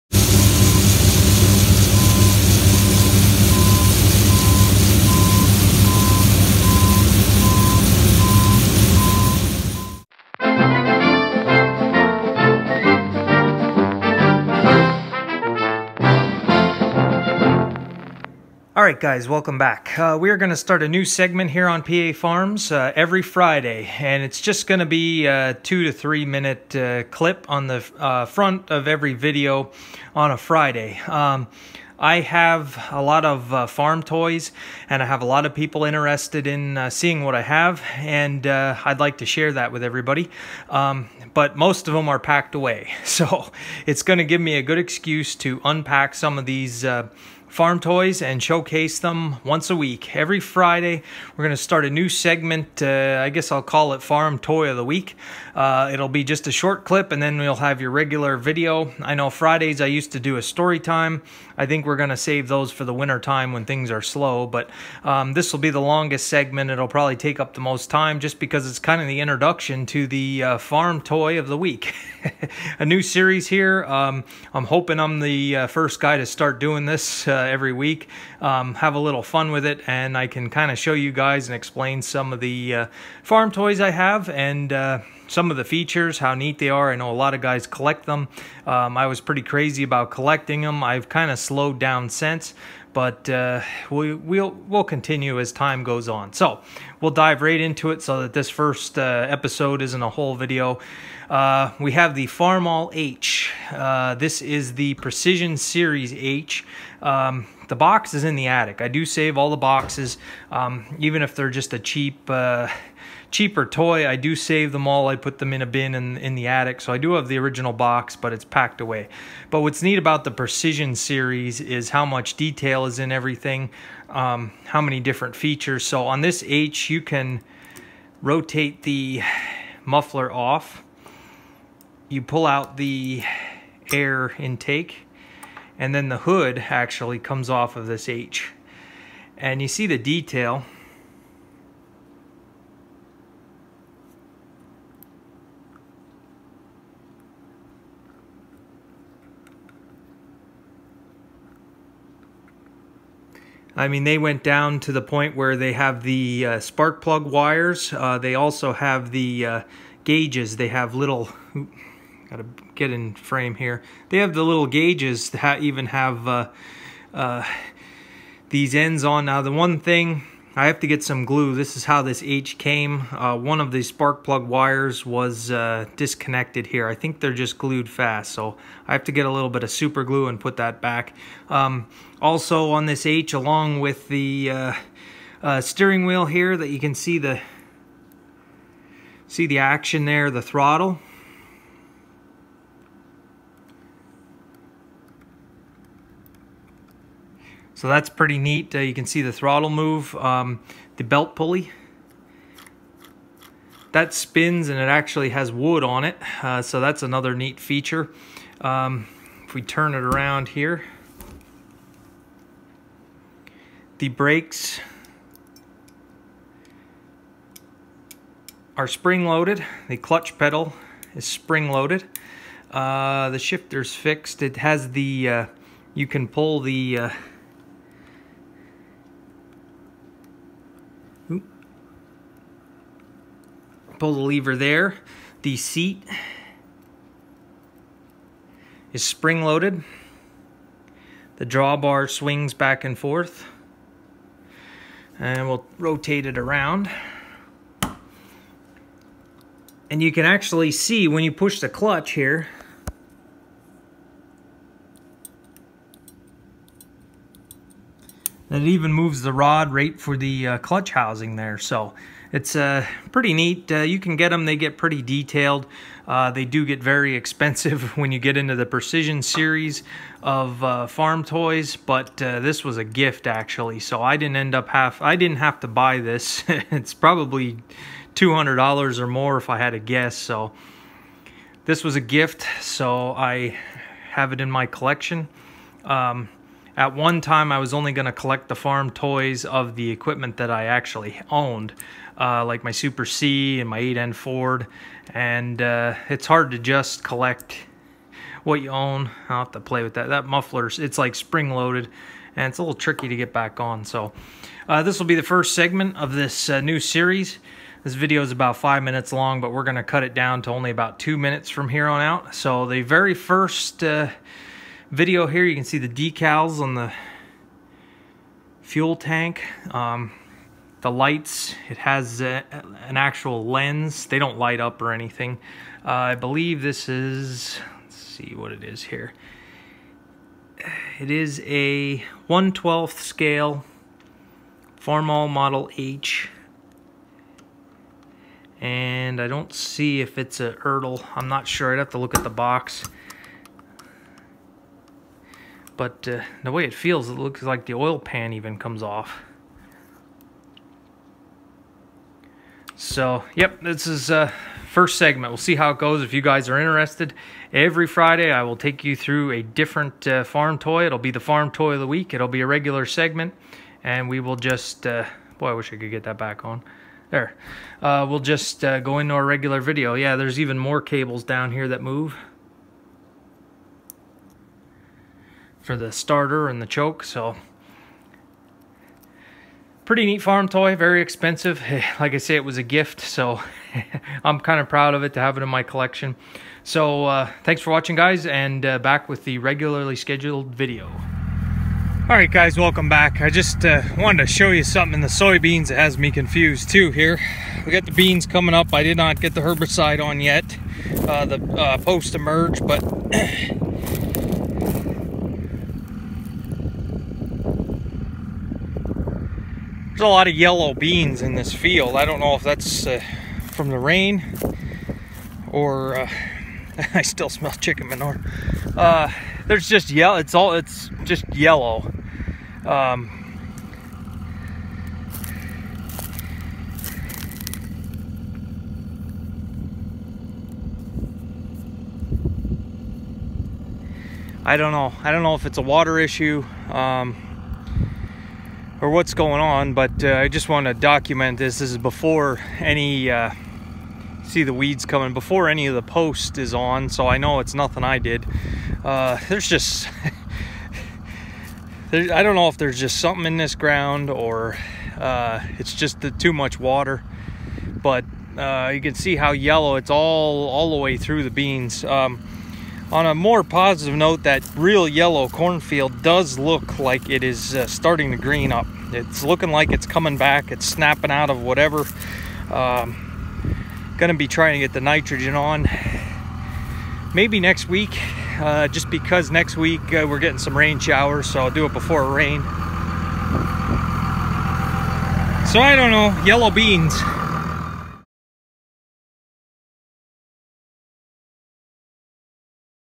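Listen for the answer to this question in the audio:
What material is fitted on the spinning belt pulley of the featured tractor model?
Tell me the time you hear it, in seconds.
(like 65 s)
205 s.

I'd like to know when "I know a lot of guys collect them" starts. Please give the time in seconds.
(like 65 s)
86 s.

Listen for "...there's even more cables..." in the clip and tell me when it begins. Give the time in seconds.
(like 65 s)
370 s.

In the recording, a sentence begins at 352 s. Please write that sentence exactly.
So, yep, this is uh, first segment.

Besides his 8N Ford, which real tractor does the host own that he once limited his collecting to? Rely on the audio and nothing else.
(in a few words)
Super C.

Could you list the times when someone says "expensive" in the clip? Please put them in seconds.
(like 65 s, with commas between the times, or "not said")
267 s, 381 s.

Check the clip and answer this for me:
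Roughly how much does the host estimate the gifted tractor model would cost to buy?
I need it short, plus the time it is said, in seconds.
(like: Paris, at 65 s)
$200, at 278 s.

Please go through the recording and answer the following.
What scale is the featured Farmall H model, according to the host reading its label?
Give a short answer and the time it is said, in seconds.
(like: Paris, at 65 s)
1/12, at 332 s.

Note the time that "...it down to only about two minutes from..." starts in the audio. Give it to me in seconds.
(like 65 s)
310 s.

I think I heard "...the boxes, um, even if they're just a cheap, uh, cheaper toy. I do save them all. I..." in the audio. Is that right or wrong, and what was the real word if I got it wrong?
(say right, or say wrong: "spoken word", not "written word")
right.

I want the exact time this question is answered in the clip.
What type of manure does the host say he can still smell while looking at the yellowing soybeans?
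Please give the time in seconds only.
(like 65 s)
417 s.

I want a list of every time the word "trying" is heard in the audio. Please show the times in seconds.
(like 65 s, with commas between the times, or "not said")
474 s.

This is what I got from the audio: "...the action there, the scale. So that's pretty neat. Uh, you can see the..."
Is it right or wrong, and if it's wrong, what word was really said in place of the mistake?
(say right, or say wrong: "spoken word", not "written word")
wrong: "throttle", not "scale".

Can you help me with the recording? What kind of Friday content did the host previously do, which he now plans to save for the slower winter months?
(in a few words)
story time.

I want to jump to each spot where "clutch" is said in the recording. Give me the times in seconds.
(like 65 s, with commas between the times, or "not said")
219 s, 251 s, 260 s.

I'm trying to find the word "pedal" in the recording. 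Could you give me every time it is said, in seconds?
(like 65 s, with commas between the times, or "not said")
220 s.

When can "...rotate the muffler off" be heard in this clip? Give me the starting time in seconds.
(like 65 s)
128 s.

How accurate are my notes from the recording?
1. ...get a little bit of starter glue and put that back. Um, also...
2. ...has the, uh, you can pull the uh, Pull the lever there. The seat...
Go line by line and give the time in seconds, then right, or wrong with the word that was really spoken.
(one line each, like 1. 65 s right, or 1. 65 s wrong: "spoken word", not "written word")
1. 179 s wrong: "super", not "starter"
2. 224 s right.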